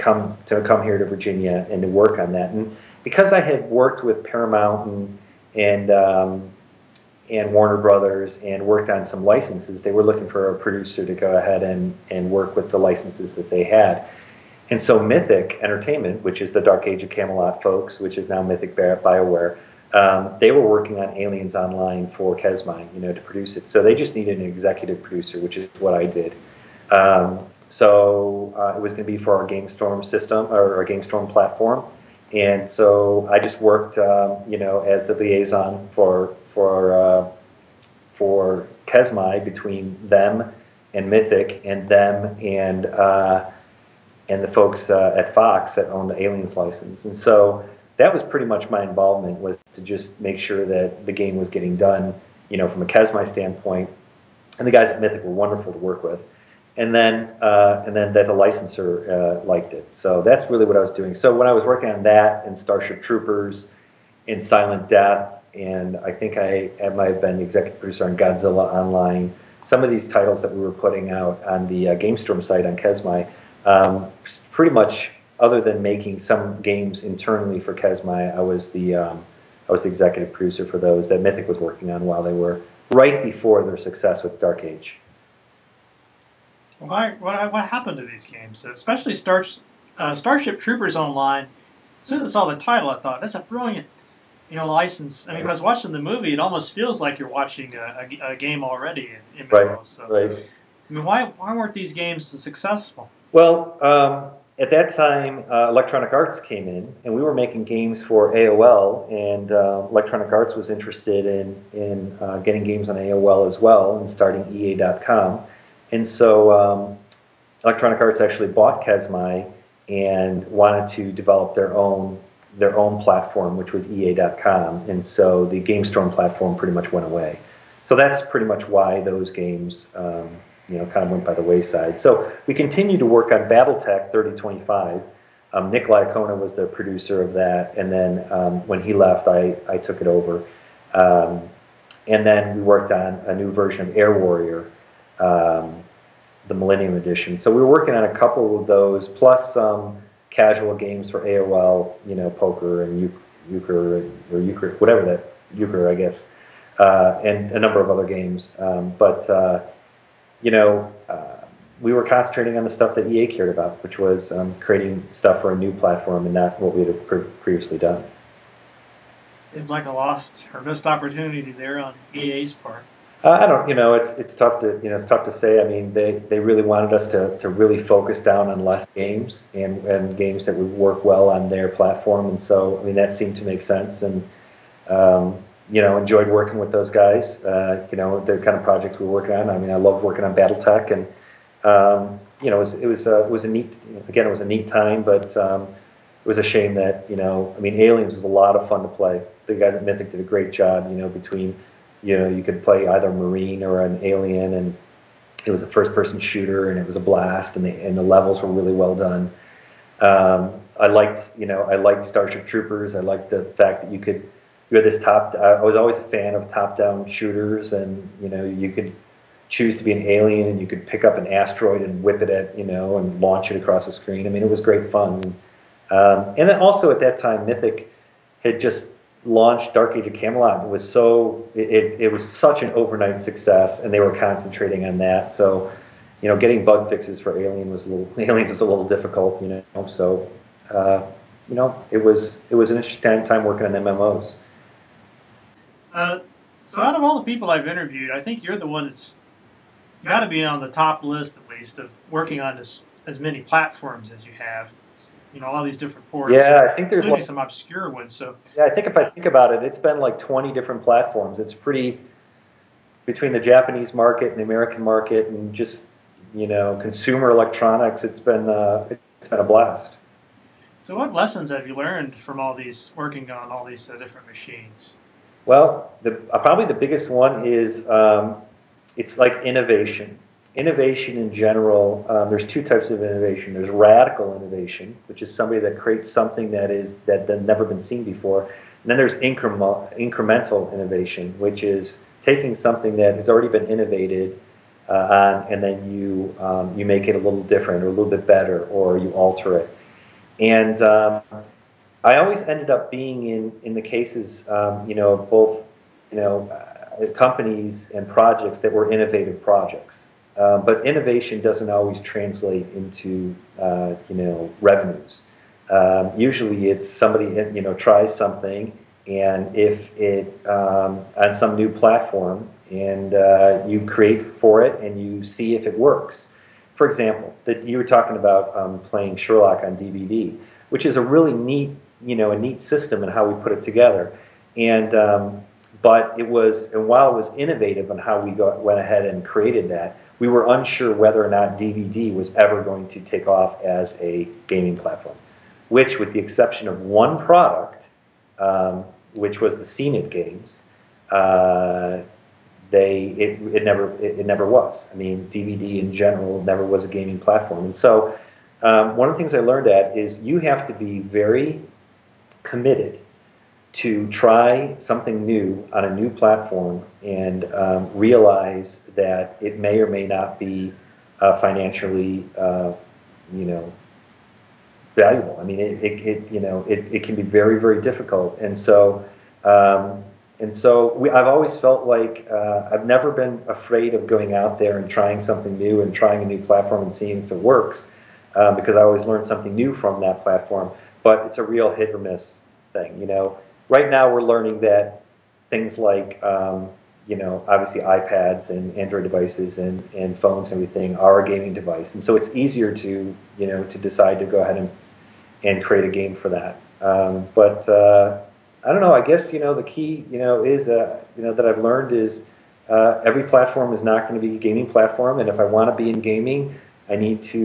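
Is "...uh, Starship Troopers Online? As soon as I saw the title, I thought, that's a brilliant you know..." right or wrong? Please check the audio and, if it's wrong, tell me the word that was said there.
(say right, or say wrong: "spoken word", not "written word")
right.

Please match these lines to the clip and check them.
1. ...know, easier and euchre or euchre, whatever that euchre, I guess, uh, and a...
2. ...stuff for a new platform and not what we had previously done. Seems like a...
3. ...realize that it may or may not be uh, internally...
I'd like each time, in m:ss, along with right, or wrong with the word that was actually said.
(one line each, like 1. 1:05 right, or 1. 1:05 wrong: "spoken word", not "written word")
1. 2:32 wrong: "poker", not "easier"
2. 2:45 right
3. 6:07 wrong: "financially", not "internally".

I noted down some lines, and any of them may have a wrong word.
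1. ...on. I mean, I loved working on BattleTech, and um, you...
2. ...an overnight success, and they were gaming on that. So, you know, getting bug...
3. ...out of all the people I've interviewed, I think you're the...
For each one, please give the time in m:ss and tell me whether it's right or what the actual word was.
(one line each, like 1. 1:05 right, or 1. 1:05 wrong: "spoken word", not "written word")
1. 3:09 right
2. 3:52 wrong: "concentrating", not "gaming"
3. 4:06 right.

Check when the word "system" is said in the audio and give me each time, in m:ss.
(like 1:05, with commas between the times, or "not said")
0:30, 5:32.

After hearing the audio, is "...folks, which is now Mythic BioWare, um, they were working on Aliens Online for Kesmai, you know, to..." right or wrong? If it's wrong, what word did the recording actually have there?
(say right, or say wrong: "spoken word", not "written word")
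right.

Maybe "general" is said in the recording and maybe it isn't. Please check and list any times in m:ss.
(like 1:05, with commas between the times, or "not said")
4:41, 5:55.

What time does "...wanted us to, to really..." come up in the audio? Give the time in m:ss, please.
2:56.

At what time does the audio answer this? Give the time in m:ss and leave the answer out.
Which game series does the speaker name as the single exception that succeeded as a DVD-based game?
5:49.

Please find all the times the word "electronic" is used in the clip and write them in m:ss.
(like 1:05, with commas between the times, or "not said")
1:45, 1:49, 1:57, 4:27.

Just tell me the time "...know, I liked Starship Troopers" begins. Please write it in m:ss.
3:31.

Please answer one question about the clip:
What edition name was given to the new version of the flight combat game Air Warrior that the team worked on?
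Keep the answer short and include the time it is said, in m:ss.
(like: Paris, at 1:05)
Millennium Edition, at 2:26.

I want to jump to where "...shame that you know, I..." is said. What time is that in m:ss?
3:16.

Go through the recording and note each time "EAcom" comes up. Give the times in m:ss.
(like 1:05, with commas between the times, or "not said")
1:54, 2:03.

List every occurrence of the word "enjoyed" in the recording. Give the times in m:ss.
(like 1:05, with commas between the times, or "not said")
3:05.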